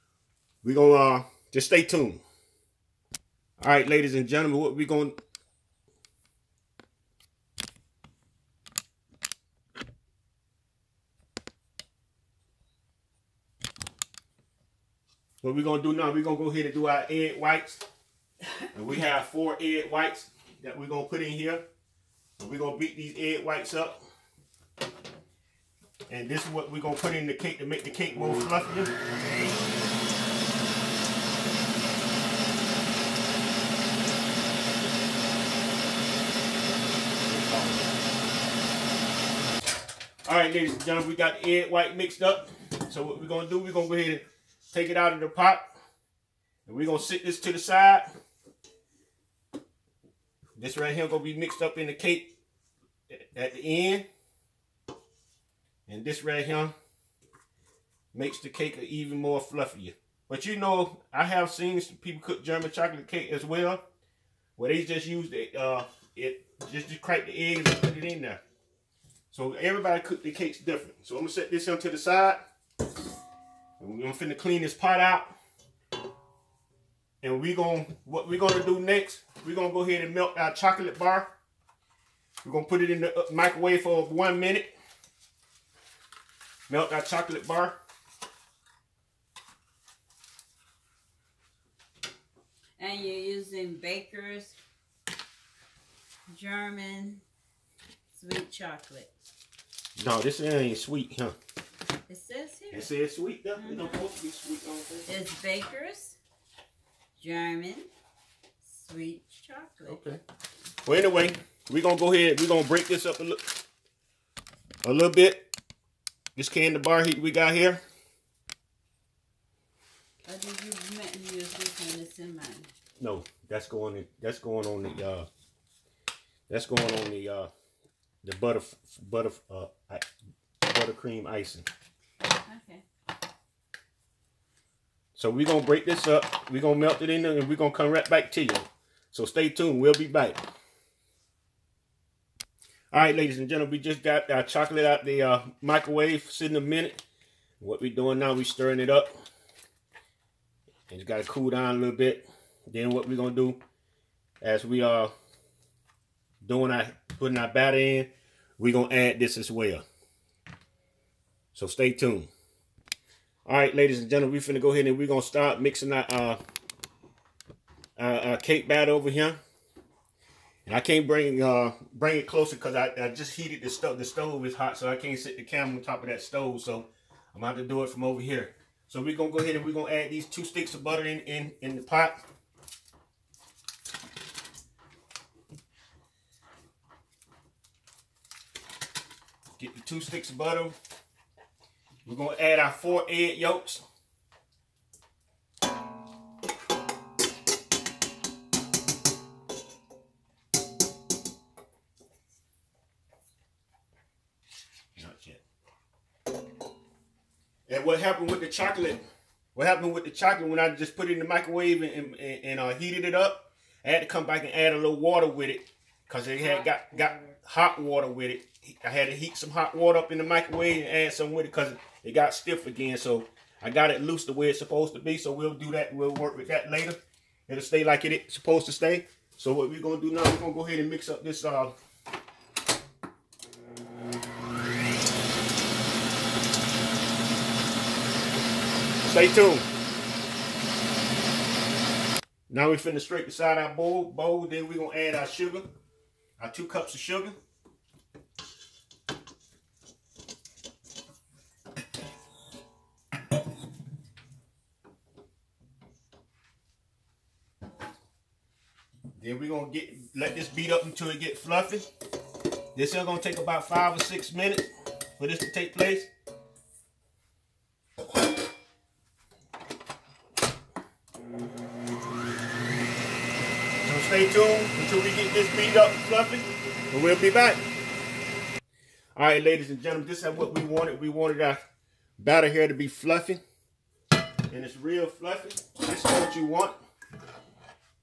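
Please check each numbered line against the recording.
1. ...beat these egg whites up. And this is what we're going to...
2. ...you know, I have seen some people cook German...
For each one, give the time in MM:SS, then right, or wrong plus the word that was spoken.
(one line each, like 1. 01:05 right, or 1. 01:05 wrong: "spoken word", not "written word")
1. 00:22 right
2. 01:00 right.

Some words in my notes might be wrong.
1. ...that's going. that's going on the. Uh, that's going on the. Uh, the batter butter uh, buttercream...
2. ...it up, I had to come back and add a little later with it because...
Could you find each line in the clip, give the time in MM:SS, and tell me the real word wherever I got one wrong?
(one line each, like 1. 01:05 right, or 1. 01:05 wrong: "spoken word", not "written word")
1. 02:03 wrong: "butter", not "batter"
2. 03:33 wrong: "water", not "later".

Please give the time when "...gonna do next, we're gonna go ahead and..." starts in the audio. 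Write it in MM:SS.
01:18.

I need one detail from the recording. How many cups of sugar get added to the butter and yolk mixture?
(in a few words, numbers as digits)
2 cups.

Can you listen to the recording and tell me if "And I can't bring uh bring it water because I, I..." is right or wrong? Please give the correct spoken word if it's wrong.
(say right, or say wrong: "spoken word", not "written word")
wrong: "closer", not "water".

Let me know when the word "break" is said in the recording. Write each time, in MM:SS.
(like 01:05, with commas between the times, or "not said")
01:52, 02:15.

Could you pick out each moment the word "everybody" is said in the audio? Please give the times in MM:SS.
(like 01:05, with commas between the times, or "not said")
01:09.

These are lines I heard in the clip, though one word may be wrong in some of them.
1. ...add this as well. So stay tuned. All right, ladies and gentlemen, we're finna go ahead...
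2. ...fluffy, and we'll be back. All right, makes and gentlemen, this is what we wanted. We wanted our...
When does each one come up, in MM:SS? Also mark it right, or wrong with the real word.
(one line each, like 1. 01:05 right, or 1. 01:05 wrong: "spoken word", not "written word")
1. 02:38 right
2. 04:36 wrong: "ladies", not "makes".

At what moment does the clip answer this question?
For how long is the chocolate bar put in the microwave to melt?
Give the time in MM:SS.
01:24.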